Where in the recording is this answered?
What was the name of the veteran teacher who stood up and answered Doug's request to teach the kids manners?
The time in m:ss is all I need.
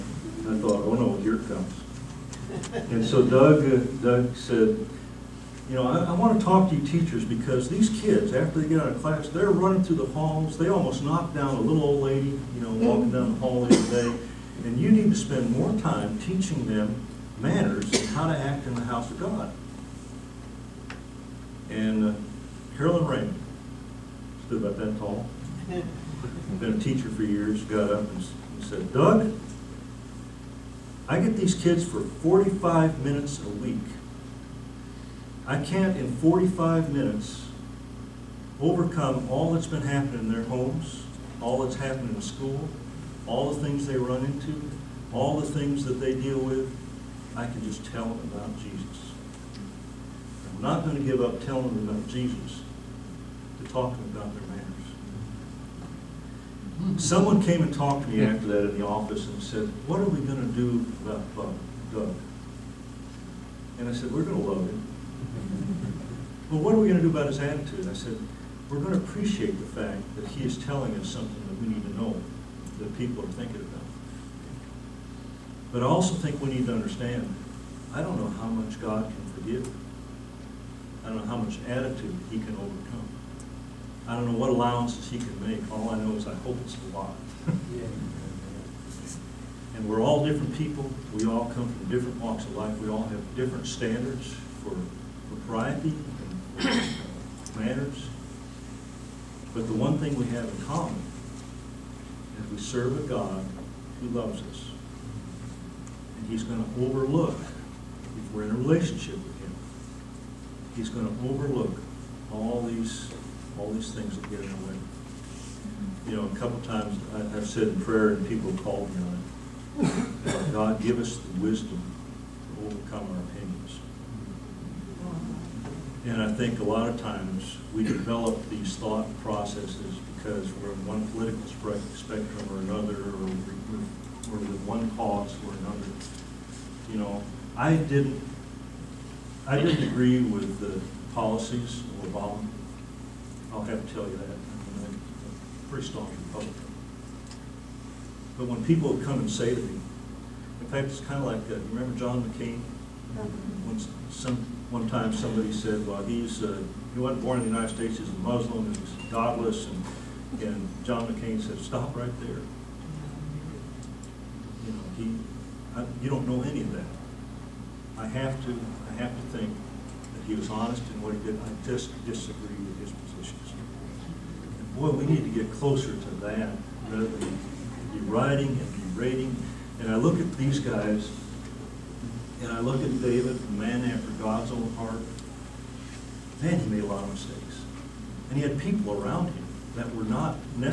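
0:22.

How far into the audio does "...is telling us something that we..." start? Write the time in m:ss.
1:10.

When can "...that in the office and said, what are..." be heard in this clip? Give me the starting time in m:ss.
0:58.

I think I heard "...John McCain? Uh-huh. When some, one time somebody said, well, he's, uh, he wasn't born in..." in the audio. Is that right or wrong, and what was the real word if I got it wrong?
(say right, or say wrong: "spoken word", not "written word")
right.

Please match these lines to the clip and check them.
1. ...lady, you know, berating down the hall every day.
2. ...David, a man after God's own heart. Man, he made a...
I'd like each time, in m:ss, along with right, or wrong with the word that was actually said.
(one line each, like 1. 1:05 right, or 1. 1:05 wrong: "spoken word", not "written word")
1. 0:12 wrong: "walking", not "berating"
2. 3:03 right.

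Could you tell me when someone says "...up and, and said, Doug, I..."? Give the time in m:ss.
0:27.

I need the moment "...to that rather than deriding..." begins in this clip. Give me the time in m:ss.
2:55.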